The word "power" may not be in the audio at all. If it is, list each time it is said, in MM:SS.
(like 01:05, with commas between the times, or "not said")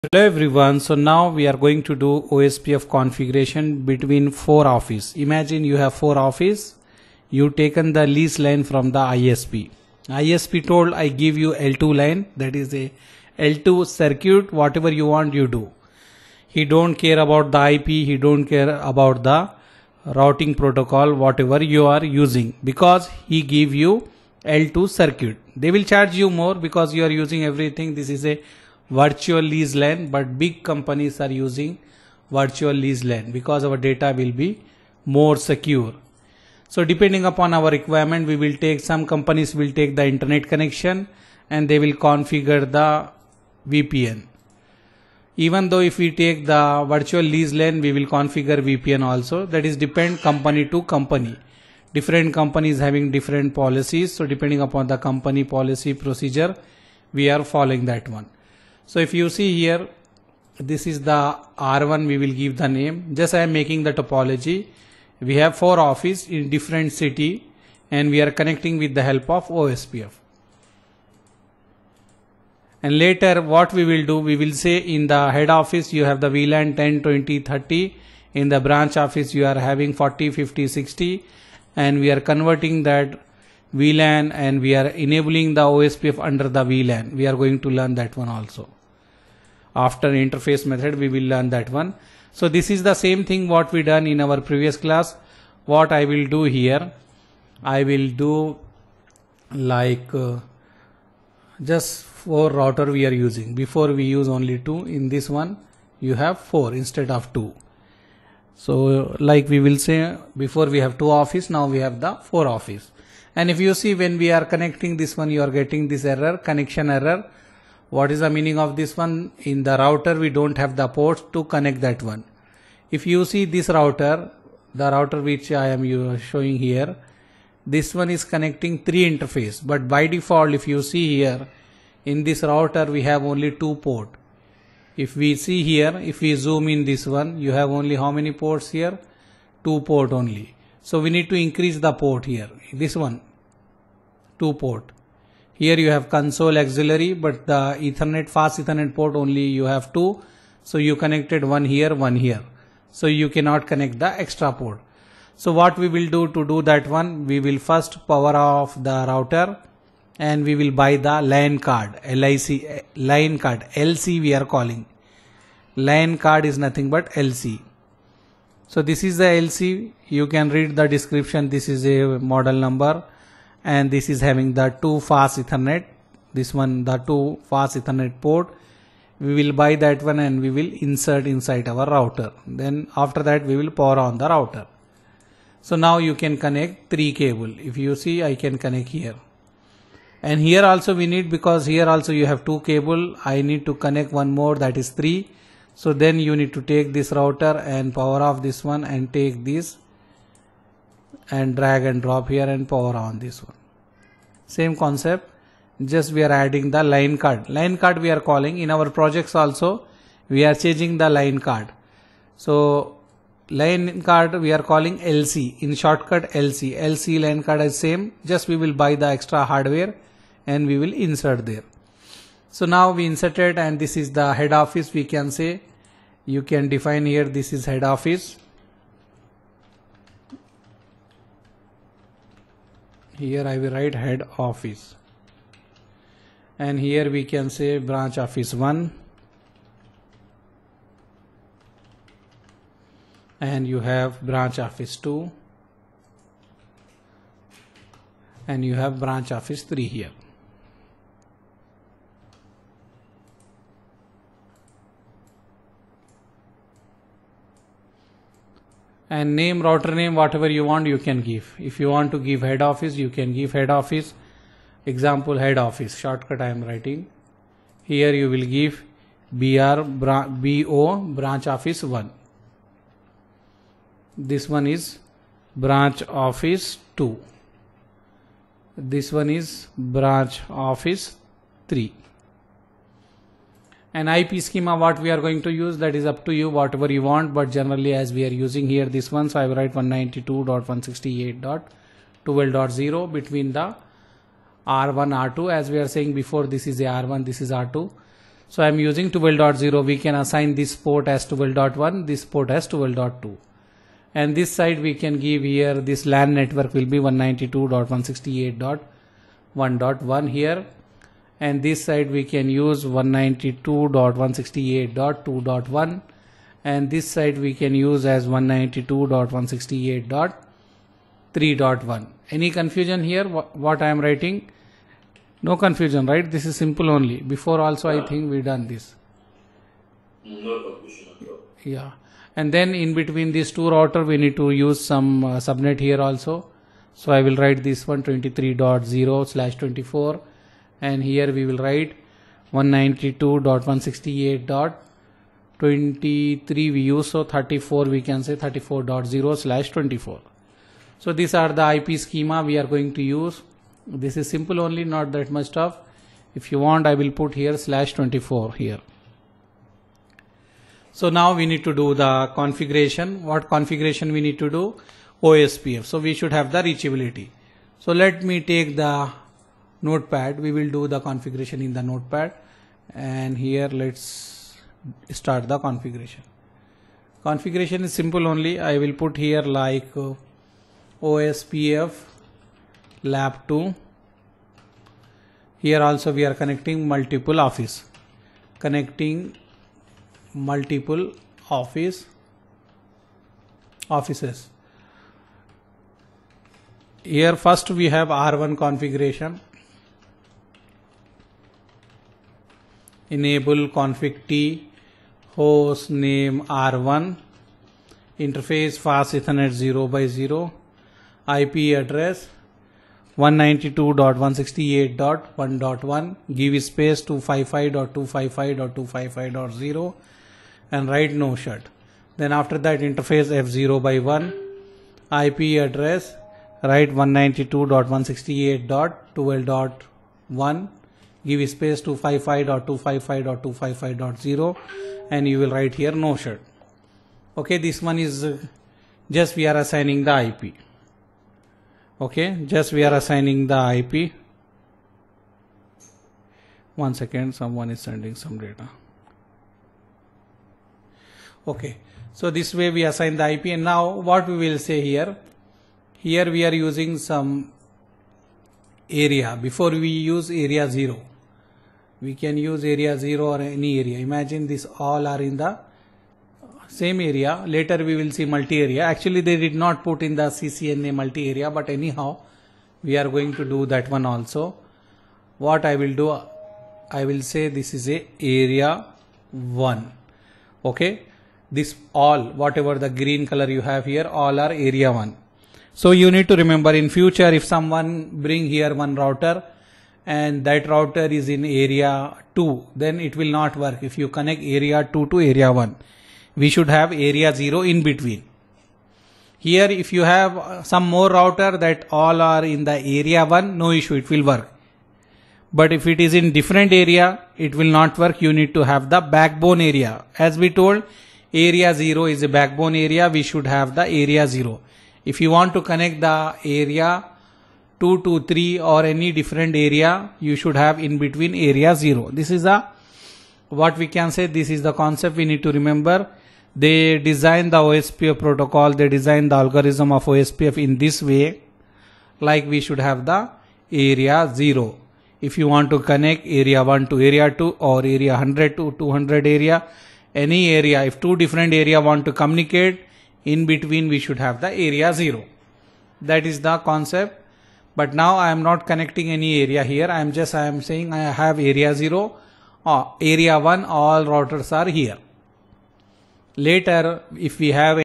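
02:38, 03:03, 03:17, 03:22.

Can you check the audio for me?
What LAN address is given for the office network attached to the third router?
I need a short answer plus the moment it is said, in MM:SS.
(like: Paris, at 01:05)
192.168.3.1, at 05:18.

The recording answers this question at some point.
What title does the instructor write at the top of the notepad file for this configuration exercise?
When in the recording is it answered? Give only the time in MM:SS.
06:21.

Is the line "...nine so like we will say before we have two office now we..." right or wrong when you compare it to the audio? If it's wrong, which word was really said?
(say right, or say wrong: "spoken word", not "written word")
wrong: "two", not "nine".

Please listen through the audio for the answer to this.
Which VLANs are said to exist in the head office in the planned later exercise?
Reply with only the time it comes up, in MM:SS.
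01:16.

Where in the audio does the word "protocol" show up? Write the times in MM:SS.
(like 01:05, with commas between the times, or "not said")
00:20, 08:48.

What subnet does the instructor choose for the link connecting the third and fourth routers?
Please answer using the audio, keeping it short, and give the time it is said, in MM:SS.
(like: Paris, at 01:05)
34.0/24, at 05:48.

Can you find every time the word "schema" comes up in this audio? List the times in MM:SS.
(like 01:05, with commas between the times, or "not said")
04:44, 05:51.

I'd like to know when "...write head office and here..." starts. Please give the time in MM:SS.
03:53.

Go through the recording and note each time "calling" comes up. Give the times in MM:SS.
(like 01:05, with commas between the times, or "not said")
02:44, 03:28, 03:34.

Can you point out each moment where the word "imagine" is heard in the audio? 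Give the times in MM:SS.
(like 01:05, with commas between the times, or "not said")
00:05, 07:44.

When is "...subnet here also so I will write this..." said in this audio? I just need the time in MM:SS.
05:35.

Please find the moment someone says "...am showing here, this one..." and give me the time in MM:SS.
02:05.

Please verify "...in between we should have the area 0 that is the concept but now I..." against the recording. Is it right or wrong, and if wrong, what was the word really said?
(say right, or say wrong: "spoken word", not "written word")
right.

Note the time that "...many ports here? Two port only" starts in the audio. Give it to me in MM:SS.
02:18.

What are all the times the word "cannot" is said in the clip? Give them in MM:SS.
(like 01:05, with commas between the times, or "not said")
02:33.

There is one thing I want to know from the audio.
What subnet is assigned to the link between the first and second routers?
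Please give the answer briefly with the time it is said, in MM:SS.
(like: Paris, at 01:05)
192.168.12.0, at 04:49.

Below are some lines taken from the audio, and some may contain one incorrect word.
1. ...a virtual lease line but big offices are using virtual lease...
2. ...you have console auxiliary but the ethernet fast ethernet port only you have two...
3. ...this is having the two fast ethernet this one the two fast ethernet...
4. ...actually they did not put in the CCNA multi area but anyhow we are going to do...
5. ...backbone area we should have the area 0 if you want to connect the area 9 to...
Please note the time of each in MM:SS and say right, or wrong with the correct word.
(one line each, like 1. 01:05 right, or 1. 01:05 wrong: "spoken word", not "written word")
1. 00:28 wrong: "companies", not "offices"
2. 02:25 right
3. 02:53 right
4. 07:48 right
5. 08:32 wrong: "2", not "9".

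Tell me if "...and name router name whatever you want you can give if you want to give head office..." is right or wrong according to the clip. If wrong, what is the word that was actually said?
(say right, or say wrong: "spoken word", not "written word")
right.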